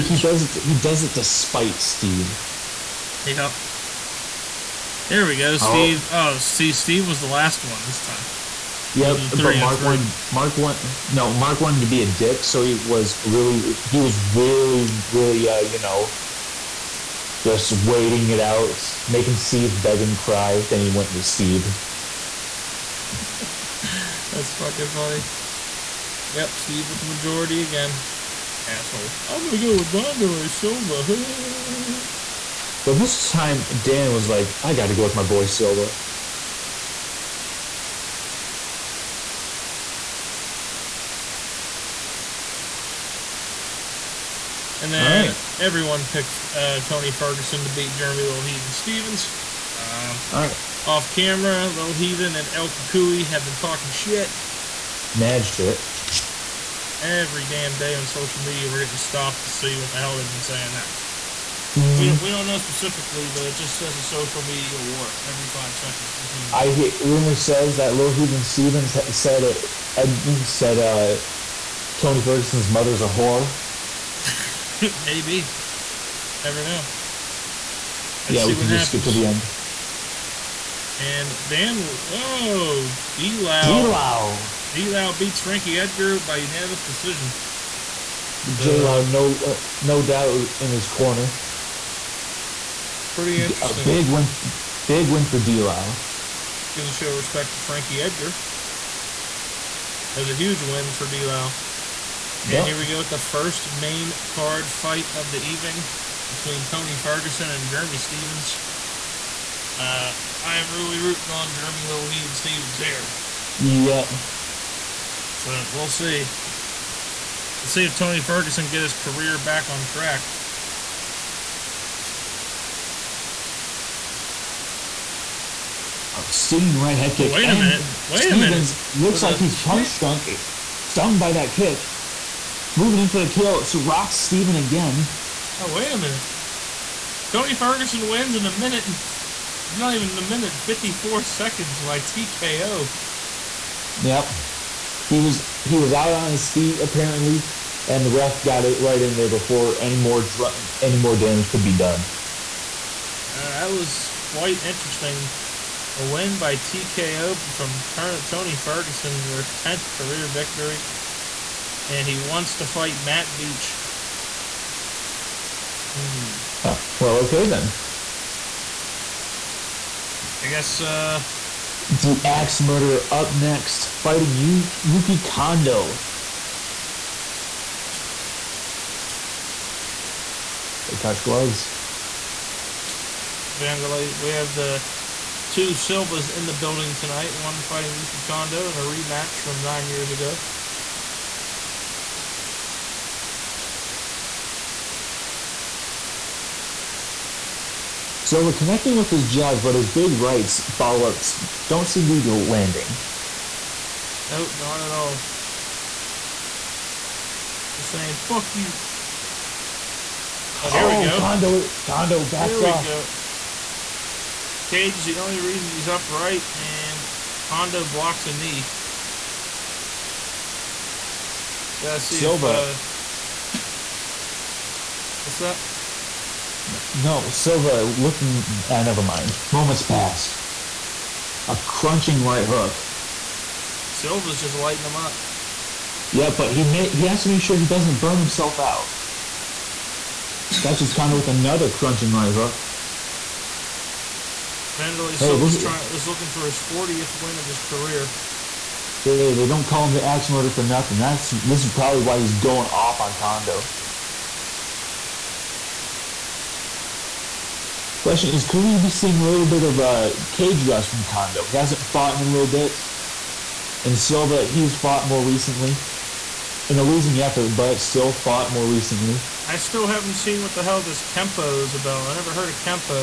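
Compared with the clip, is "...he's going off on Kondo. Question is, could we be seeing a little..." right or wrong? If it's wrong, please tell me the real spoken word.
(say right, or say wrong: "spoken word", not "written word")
right.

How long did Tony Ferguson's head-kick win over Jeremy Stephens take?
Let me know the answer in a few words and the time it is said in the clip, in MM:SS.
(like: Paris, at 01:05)
54 seconds, at 02:20.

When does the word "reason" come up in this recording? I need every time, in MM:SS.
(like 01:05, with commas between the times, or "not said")
03:35.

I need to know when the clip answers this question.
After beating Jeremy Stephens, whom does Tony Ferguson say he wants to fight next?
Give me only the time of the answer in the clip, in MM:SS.
02:43.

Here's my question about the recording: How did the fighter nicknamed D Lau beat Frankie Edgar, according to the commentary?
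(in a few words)
Unanimous decision.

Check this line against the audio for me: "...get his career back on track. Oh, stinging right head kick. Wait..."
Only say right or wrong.
right.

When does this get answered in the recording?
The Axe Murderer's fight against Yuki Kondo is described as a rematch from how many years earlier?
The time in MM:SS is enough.
03:09.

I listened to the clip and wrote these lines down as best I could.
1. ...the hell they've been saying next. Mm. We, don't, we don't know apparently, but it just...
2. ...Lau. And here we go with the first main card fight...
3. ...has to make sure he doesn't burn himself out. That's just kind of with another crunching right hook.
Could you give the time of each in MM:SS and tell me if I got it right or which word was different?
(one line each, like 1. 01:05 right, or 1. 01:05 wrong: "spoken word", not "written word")
1. 00:59 wrong: "specifically", not "apparently"
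2. 01:41 right
3. 03:57 right.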